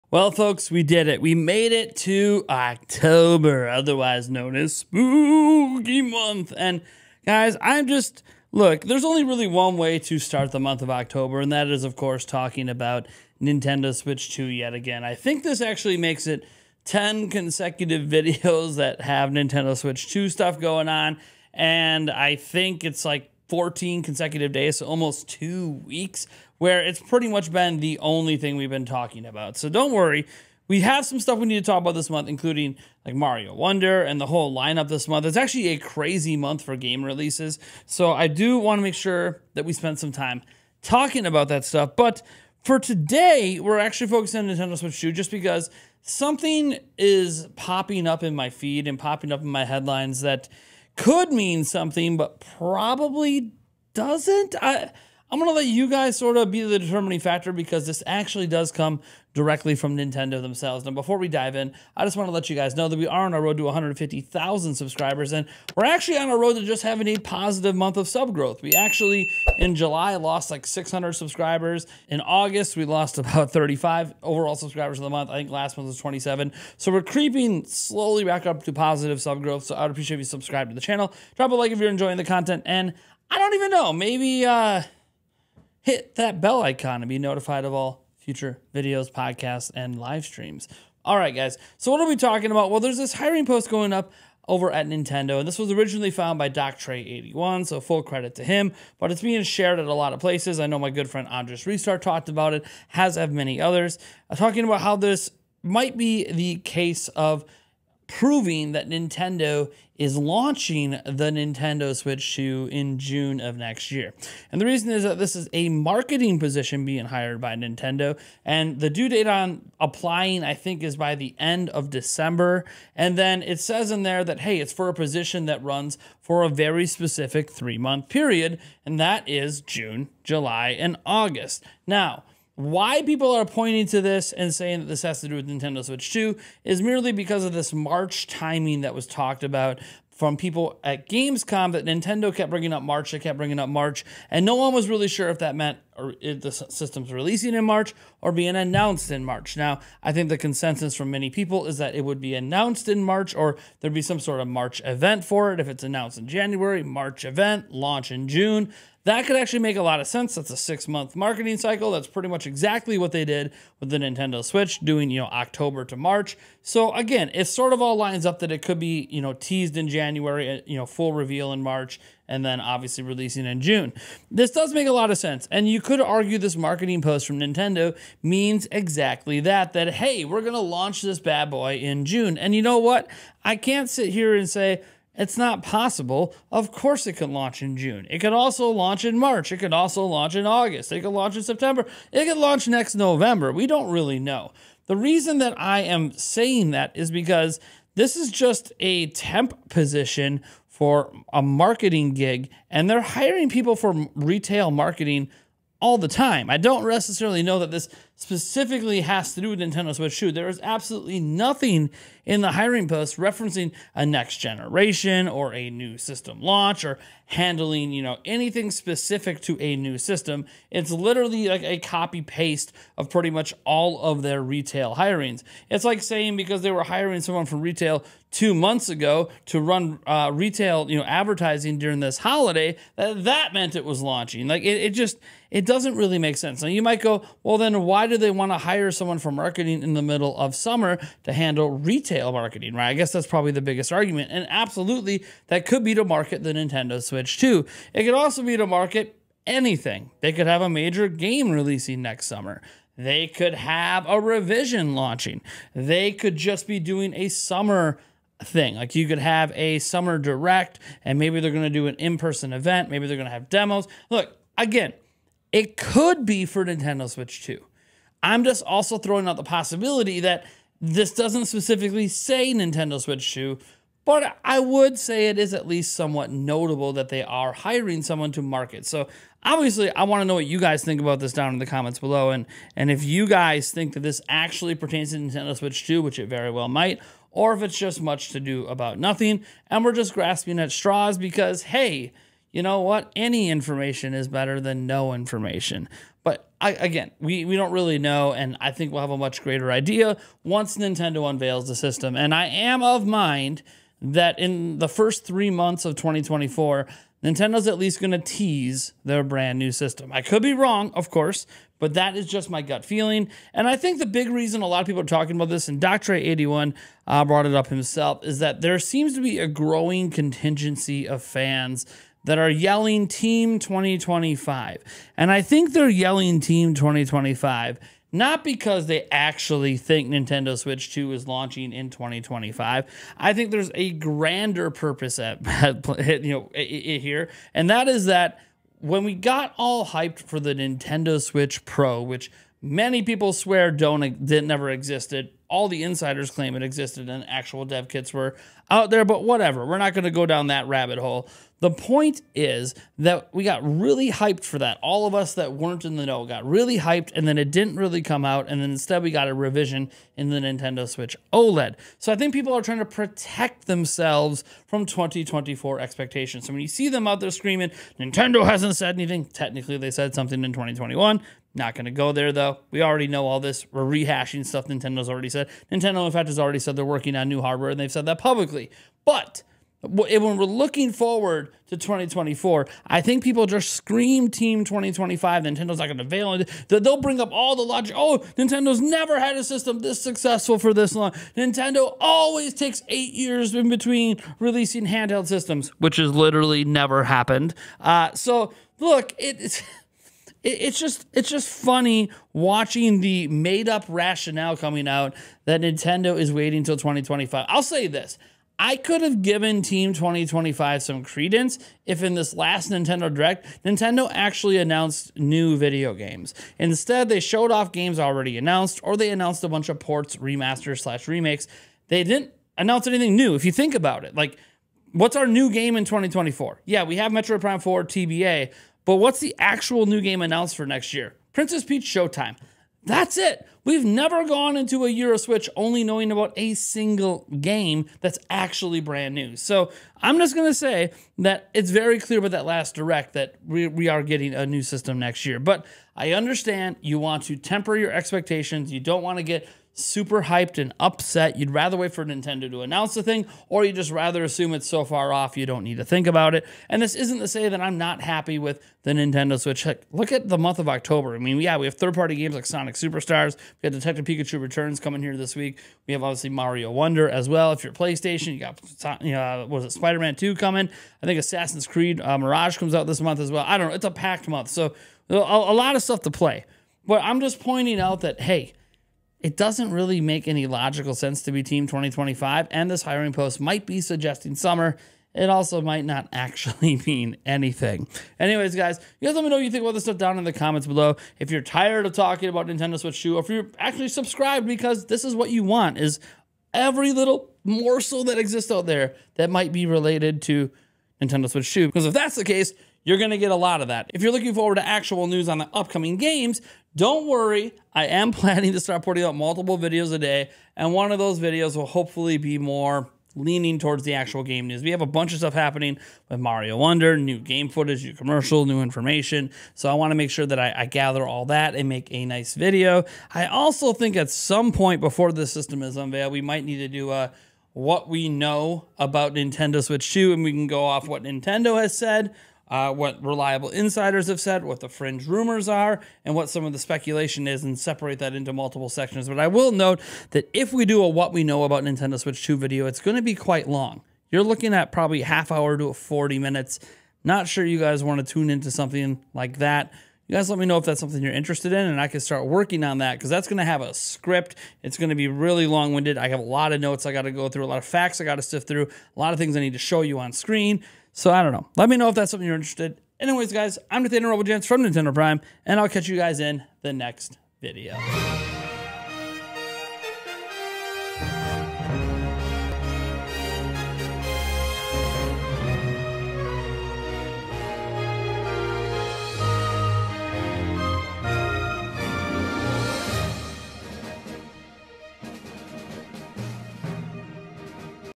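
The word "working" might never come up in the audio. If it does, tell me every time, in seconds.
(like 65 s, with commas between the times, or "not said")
376 s, 552 s.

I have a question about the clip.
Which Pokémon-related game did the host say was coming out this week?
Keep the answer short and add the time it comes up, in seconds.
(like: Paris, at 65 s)
Detective Pikachu Returns, at 463 s.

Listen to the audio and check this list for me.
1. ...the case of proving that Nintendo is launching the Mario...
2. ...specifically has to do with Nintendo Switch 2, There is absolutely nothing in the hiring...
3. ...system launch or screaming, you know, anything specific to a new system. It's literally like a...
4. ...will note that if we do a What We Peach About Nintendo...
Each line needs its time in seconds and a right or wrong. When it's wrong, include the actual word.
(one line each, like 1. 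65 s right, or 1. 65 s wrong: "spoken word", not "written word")
1. 106 s wrong: "Nintendo", not "Mario"
2. 208 s right
3. 215 s wrong: "handling", not "screaming"
4. 539 s wrong: "Know", not "Peach".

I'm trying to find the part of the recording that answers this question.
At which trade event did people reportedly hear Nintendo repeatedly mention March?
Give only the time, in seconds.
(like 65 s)
141 s.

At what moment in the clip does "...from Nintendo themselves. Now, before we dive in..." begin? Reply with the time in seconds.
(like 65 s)
59 s.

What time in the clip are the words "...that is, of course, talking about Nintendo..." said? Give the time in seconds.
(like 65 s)
11 s.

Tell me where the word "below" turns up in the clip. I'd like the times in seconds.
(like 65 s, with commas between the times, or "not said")
281 s, 490 s.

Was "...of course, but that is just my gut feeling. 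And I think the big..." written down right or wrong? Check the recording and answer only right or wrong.
right.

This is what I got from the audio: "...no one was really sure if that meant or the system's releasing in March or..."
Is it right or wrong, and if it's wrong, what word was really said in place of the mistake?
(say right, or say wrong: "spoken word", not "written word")
right.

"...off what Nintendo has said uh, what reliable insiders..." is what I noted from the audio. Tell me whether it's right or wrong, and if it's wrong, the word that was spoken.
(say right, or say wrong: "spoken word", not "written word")
right.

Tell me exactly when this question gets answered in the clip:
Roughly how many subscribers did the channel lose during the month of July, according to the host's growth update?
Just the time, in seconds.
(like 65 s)
70 s.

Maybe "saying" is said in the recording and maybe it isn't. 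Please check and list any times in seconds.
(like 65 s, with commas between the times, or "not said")
134 s, 196 s, 226 s.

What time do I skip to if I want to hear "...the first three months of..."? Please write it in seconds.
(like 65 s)
304 s.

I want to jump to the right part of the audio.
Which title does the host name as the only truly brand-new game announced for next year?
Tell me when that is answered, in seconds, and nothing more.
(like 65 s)
431 s.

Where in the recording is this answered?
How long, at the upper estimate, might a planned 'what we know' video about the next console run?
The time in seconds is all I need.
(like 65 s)
545 s.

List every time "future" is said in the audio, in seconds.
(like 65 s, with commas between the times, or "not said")
88 s.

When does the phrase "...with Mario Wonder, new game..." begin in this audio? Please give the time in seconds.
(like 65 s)
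516 s.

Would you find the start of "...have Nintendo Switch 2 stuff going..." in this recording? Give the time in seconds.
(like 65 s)
18 s.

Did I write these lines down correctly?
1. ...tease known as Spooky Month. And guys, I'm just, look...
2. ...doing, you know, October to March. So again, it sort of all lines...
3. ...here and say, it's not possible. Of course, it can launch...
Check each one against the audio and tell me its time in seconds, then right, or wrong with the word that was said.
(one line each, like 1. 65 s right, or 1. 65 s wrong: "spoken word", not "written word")
1. 3 s wrong: "otherwise", not "tease"
2. 164 s right
3. 184 s right.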